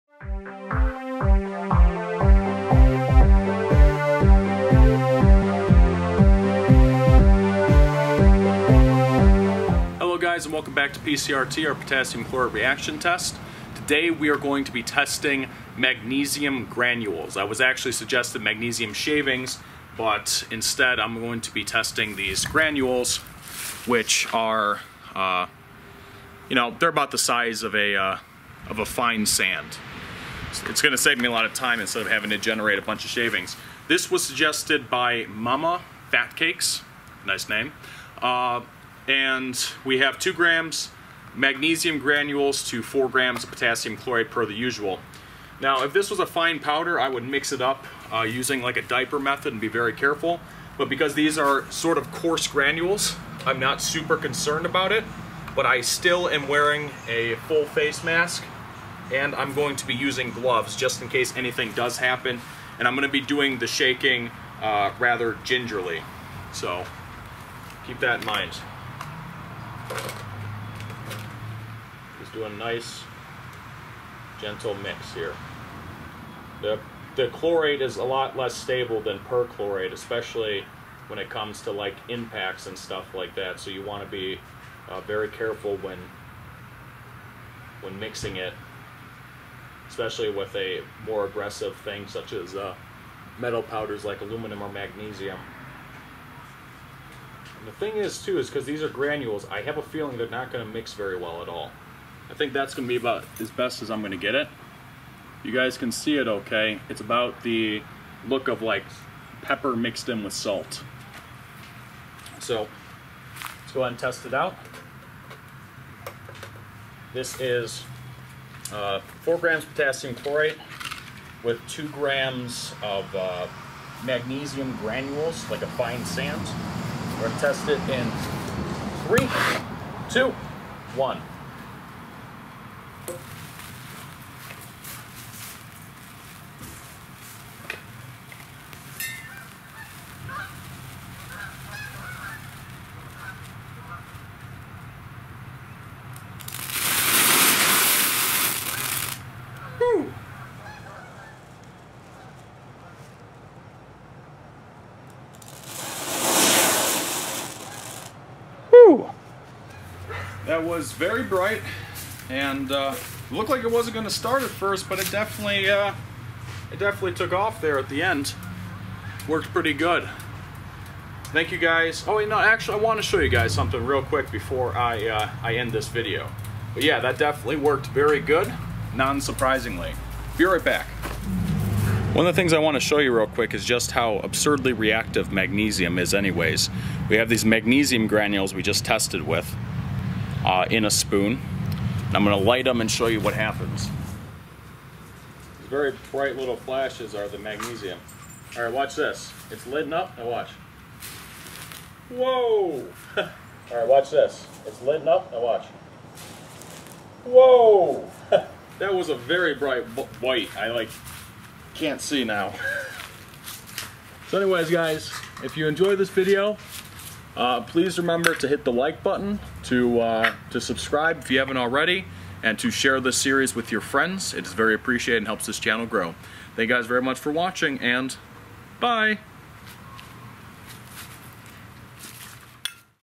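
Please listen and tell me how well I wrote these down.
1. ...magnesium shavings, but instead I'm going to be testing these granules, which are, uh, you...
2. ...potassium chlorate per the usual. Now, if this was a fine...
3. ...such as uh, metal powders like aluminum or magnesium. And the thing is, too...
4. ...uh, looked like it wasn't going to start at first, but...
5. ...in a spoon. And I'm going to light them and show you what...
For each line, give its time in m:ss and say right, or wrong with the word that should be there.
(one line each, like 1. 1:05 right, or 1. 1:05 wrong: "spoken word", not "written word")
1. 0:18 right
2. 0:43 right
3. 1:32 right
4. 2:42 right
5. 3:10 right.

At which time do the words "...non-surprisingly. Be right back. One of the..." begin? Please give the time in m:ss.
2:58.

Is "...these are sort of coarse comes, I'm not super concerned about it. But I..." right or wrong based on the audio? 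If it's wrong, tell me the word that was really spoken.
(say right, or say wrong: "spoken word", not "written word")
wrong: "granules", not "comes".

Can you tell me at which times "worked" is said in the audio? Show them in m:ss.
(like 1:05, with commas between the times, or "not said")
2:49, 2:57.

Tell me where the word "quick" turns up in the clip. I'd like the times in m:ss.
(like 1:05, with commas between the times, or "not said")
2:54, 3:03.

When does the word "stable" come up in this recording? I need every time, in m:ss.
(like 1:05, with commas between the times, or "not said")
1:18.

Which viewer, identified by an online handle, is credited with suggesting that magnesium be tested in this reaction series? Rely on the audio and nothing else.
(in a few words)
Mama Fat Cakes.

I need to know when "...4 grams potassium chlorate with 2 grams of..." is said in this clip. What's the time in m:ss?
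1:59.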